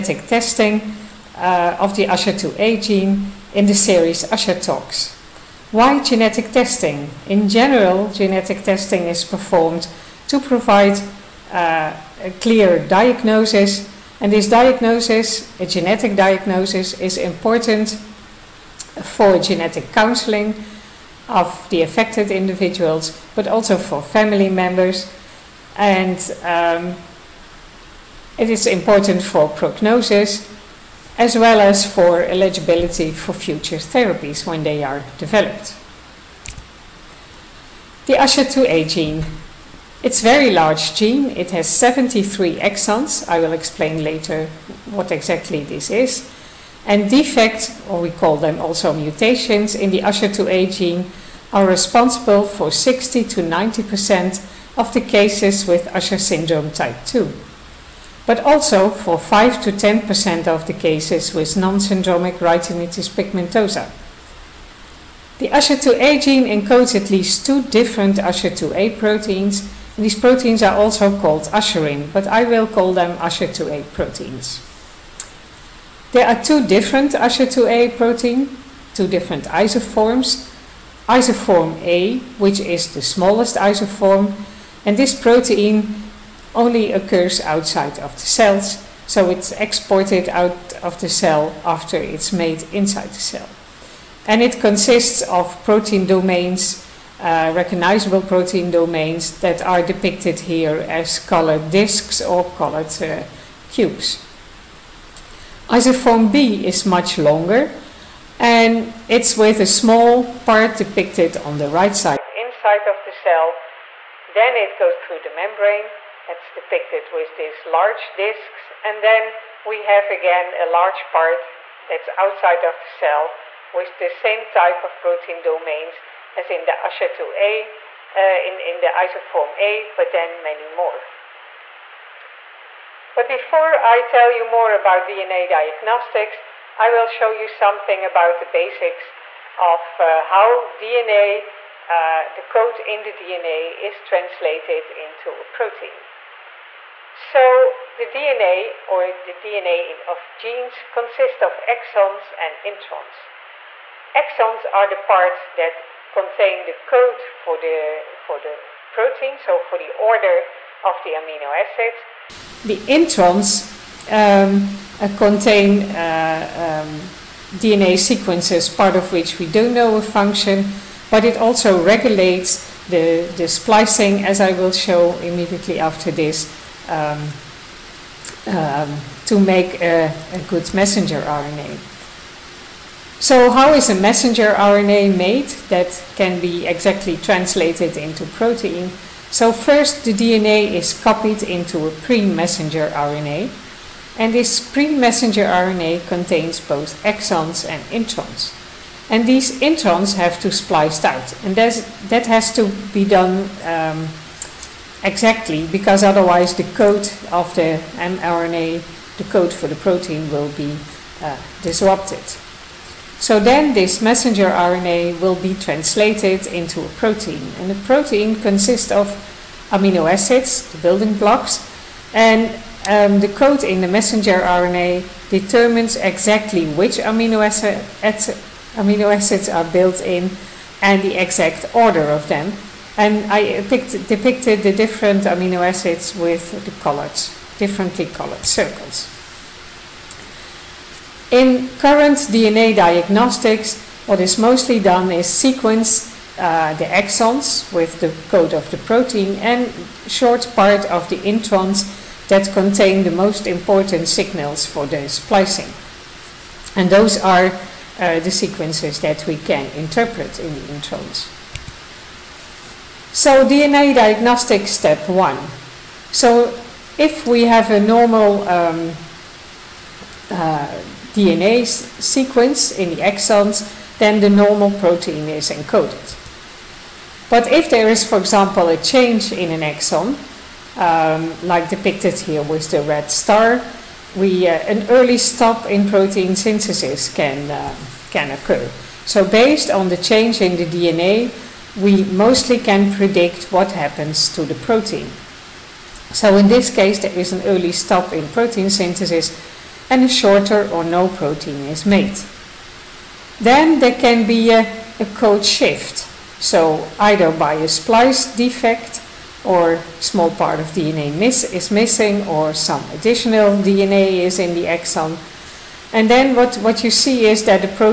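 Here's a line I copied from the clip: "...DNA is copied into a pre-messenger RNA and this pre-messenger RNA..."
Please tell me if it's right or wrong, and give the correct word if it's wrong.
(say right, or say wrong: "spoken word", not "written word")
right.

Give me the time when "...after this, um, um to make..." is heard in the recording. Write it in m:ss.
2:55.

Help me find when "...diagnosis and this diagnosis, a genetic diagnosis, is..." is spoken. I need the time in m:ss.
0:12.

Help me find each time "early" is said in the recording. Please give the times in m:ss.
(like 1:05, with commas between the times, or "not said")
4:44, 4:57.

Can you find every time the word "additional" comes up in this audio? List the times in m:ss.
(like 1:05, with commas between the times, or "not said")
5:12.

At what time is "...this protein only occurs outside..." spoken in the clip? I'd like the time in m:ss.
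1:24.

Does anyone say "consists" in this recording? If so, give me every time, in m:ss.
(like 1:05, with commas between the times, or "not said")
1:34, 2:30, 3:38.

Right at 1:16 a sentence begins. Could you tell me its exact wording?
There are two different Usher2A protein, two different isoforms.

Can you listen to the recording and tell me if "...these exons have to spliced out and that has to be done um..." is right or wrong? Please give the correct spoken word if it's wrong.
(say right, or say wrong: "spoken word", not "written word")
wrong: "introns", not "exons".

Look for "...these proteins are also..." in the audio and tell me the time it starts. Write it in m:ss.
1:09.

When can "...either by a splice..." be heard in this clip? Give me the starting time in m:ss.
5:06.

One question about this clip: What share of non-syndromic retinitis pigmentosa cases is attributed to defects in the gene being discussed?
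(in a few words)
5 to 10%.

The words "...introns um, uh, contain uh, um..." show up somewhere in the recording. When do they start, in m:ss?
2:42.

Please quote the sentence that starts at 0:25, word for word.
And um, it is important for prognosis as well as for eligibility for future therapies when they are developed.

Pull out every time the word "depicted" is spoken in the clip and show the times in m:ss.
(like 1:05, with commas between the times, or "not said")
1:39, 1:50, 1:56, 3:54, 4:41.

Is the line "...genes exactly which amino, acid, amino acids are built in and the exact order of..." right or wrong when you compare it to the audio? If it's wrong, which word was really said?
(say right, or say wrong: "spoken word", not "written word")
wrong: "determines", not "genes".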